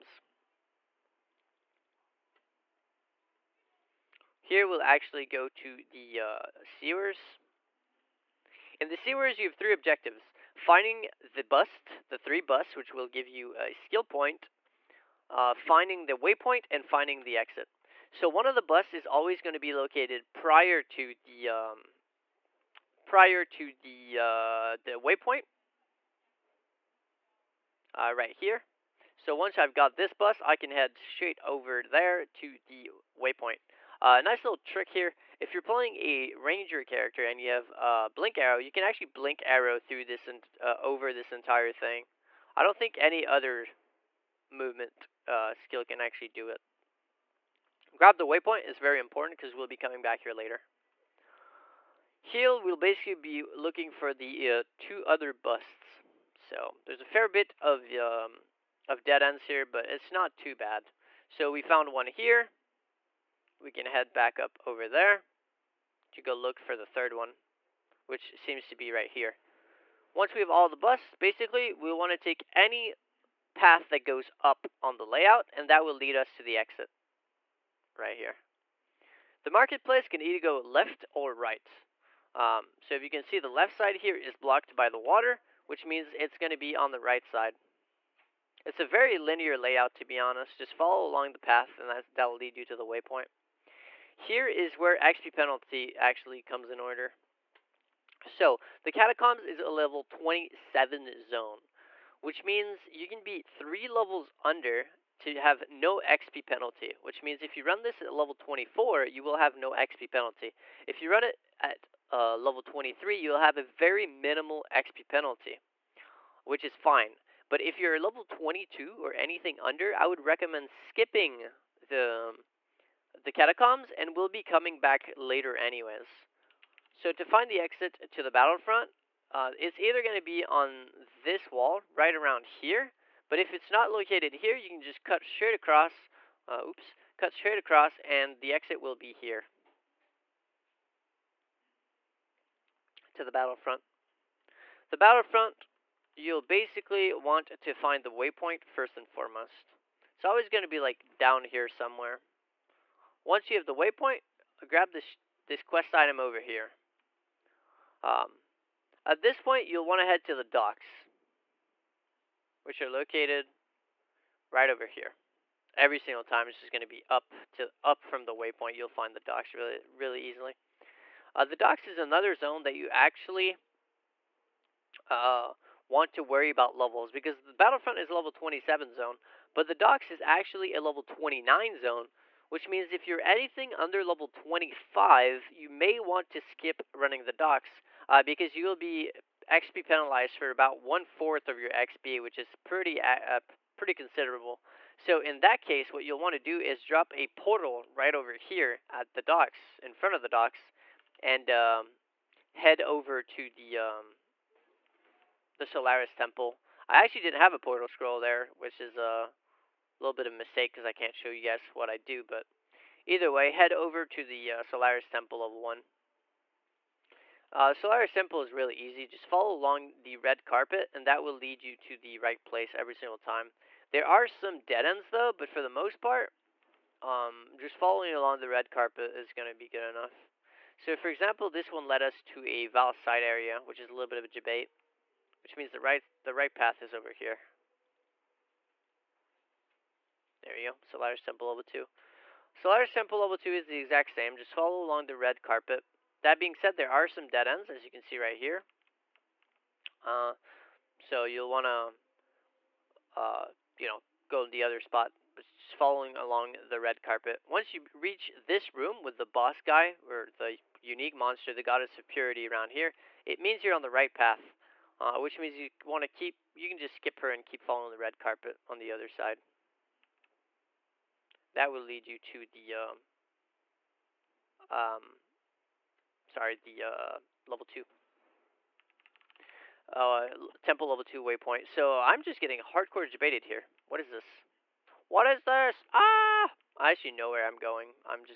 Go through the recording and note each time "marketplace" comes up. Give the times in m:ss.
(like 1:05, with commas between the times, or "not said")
1:19.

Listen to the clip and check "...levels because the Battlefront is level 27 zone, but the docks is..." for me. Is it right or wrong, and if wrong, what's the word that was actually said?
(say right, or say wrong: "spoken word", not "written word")
right.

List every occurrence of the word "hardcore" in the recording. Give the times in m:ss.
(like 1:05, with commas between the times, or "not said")
4:42.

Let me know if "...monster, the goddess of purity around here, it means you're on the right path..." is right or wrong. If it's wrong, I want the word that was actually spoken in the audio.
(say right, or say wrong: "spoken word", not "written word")
right.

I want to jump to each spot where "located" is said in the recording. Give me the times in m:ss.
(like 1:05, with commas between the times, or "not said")
0:19, 2:13, 2:42.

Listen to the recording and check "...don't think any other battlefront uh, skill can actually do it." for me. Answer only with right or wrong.
wrong.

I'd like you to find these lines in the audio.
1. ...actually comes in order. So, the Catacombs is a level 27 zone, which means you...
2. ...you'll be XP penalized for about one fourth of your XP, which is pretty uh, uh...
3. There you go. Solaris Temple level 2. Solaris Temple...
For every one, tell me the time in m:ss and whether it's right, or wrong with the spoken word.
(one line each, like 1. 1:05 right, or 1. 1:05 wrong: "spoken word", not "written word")
1. 1:35 right
2. 3:08 right
3. 4:00 right.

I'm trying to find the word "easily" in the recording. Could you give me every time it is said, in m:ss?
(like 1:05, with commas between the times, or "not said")
2:50.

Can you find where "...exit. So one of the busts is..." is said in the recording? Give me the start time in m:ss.
0:17.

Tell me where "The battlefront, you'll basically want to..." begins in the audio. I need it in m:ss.
2:24.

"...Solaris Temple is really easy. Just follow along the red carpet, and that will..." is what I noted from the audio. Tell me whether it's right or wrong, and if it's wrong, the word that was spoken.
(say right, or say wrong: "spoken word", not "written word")
right.